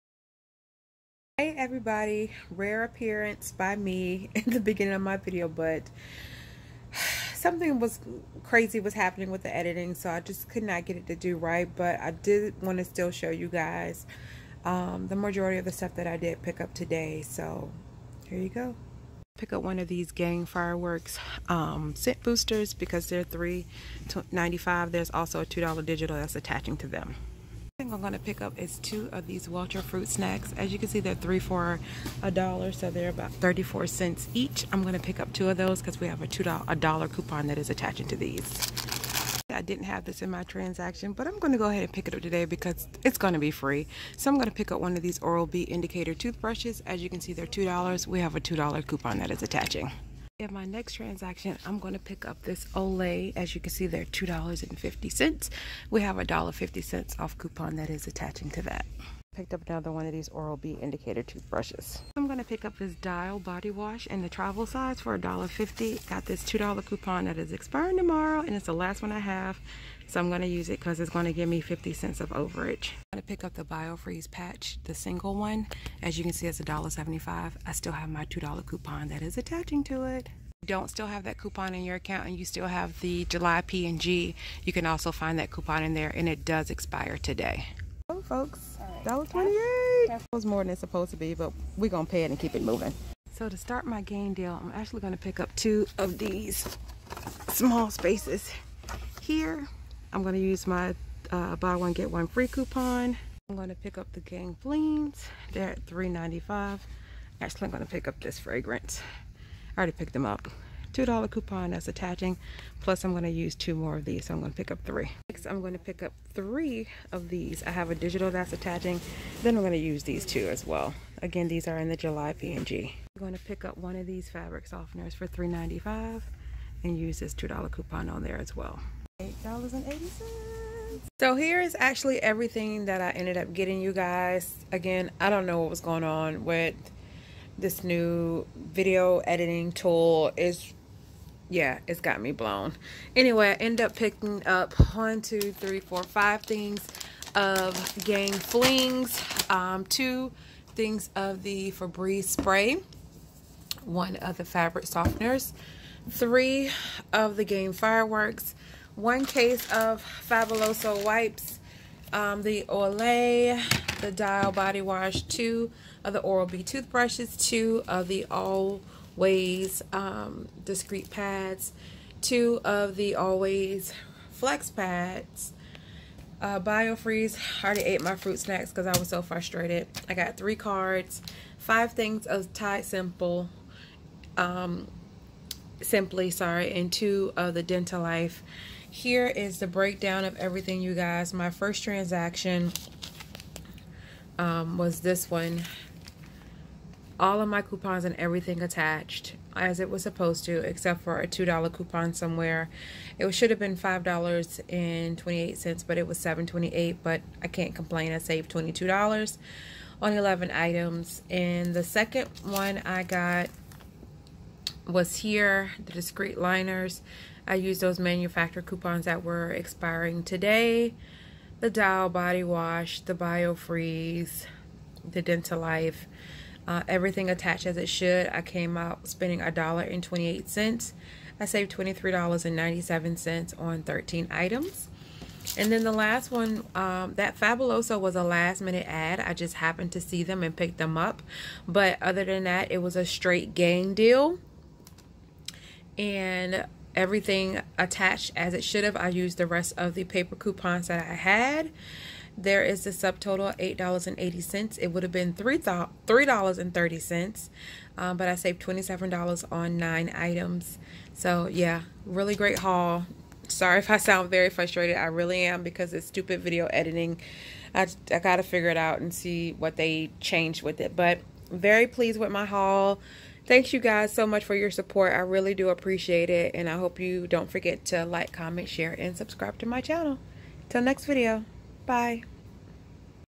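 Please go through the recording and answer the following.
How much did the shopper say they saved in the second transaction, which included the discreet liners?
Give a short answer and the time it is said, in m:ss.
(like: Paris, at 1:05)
$23.97, at 3:51.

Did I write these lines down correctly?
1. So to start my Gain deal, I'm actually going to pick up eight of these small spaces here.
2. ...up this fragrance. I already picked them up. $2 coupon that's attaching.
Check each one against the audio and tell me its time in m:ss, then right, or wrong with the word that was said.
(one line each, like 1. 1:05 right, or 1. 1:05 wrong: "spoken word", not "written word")
1. 1:33 wrong: "two", not "eight"
2. 1:48 right.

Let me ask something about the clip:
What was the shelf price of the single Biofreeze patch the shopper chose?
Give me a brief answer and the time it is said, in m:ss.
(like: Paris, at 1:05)
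$1.75, at 1:16.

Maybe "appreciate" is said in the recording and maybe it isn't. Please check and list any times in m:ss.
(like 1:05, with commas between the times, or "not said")
4:35.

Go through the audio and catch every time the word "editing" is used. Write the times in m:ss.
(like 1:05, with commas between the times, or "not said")
0:09, 2:19, 4:26.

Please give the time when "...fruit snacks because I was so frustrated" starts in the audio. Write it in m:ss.
2:58.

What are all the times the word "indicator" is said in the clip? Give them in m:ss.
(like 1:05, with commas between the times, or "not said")
0:45, 1:00.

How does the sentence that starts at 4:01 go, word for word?
But other than that, it was a straight Gain deal.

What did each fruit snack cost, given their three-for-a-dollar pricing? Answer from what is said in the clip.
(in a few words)
34 cents.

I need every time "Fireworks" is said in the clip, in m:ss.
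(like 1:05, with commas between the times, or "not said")
0:20, 2:37.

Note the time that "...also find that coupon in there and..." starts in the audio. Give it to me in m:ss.
1:24.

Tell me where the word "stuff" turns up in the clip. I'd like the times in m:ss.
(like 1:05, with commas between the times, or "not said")
0:15.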